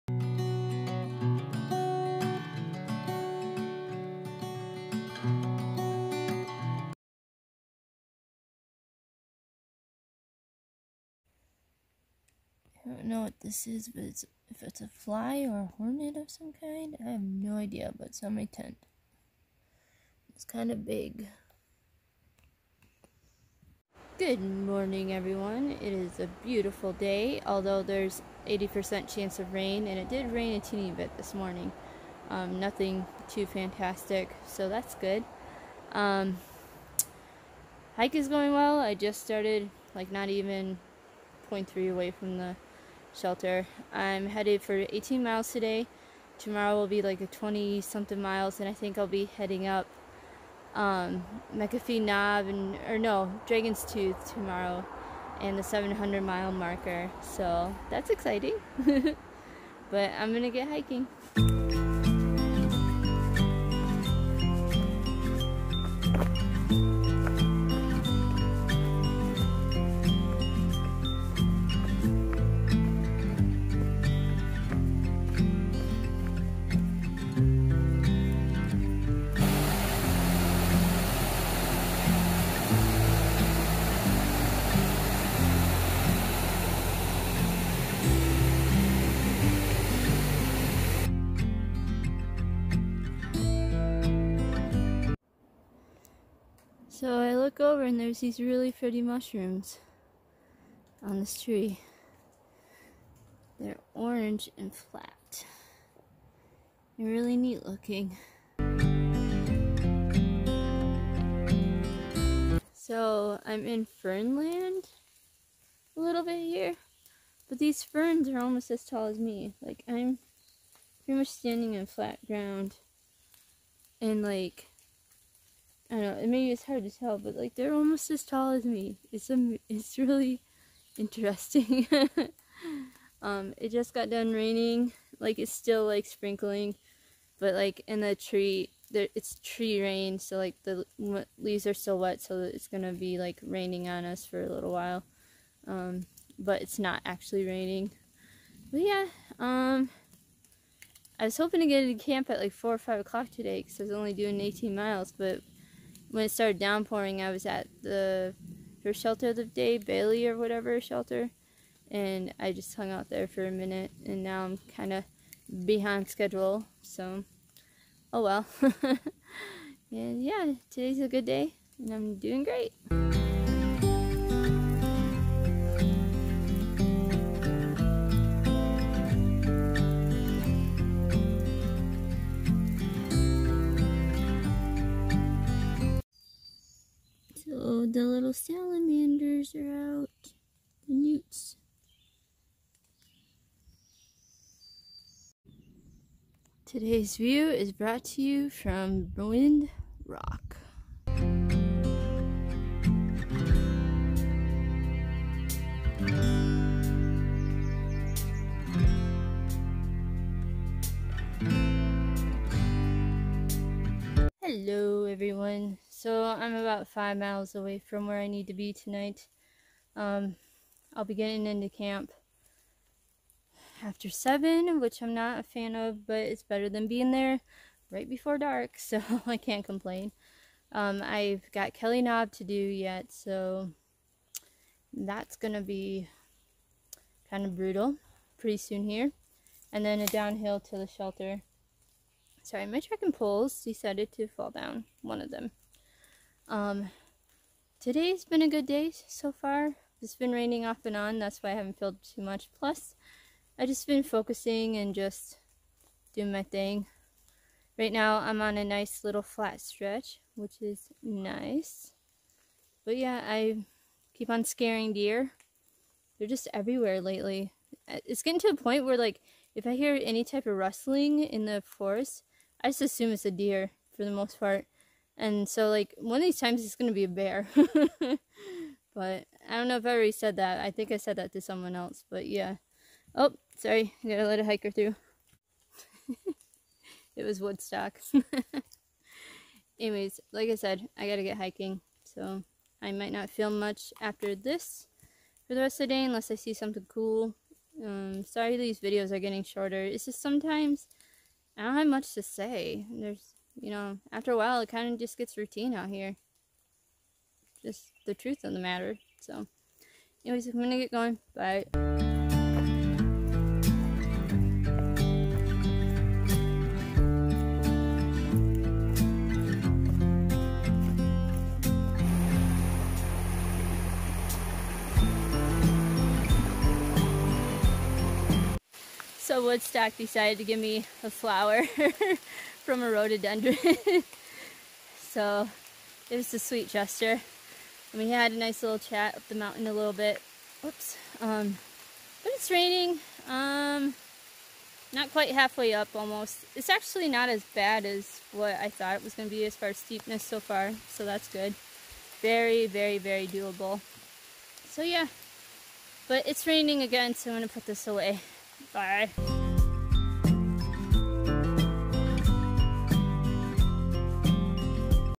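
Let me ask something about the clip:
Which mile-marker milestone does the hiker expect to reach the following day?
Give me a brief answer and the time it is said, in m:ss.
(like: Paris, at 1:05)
700, at 0:55.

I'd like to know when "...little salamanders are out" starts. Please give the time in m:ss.
3:08.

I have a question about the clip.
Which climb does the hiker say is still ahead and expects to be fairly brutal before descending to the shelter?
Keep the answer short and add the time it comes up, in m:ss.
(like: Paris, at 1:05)
Kelly Knob, at 3:51.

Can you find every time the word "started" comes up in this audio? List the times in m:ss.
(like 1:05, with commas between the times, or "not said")
0:39, 2:36.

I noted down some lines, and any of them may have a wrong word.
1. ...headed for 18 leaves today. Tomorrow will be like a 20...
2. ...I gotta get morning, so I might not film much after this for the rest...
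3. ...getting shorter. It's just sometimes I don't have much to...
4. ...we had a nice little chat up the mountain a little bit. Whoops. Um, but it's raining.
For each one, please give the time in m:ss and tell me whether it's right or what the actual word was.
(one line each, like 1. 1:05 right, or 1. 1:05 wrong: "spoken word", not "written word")
1. 0:44 wrong: "miles", not "leaves"
2. 4:50 wrong: "hiking", not "morning"
3. 4:59 right
4. 5:38 right.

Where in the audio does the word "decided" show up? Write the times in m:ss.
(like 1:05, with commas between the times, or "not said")
4:03, 5:29.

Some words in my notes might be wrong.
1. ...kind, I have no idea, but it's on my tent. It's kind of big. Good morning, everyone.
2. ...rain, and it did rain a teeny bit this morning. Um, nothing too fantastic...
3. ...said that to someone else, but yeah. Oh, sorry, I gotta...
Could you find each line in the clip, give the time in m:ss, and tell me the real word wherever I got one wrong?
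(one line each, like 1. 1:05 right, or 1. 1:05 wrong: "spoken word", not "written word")
1. 0:16 right
2. 0:29 right
3. 4:40 right.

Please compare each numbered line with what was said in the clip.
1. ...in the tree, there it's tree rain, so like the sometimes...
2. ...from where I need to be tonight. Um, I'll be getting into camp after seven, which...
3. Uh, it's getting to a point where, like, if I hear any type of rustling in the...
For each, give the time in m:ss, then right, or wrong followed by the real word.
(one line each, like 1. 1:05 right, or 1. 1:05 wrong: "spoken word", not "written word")
1. 2:17 wrong: "leaves", not "sometimes"
2. 3:37 right
3. 4:27 right.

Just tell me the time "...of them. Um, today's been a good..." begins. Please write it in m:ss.
4:05.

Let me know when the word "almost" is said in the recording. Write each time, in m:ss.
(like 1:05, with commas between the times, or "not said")
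1:58, 2:07, 5:45.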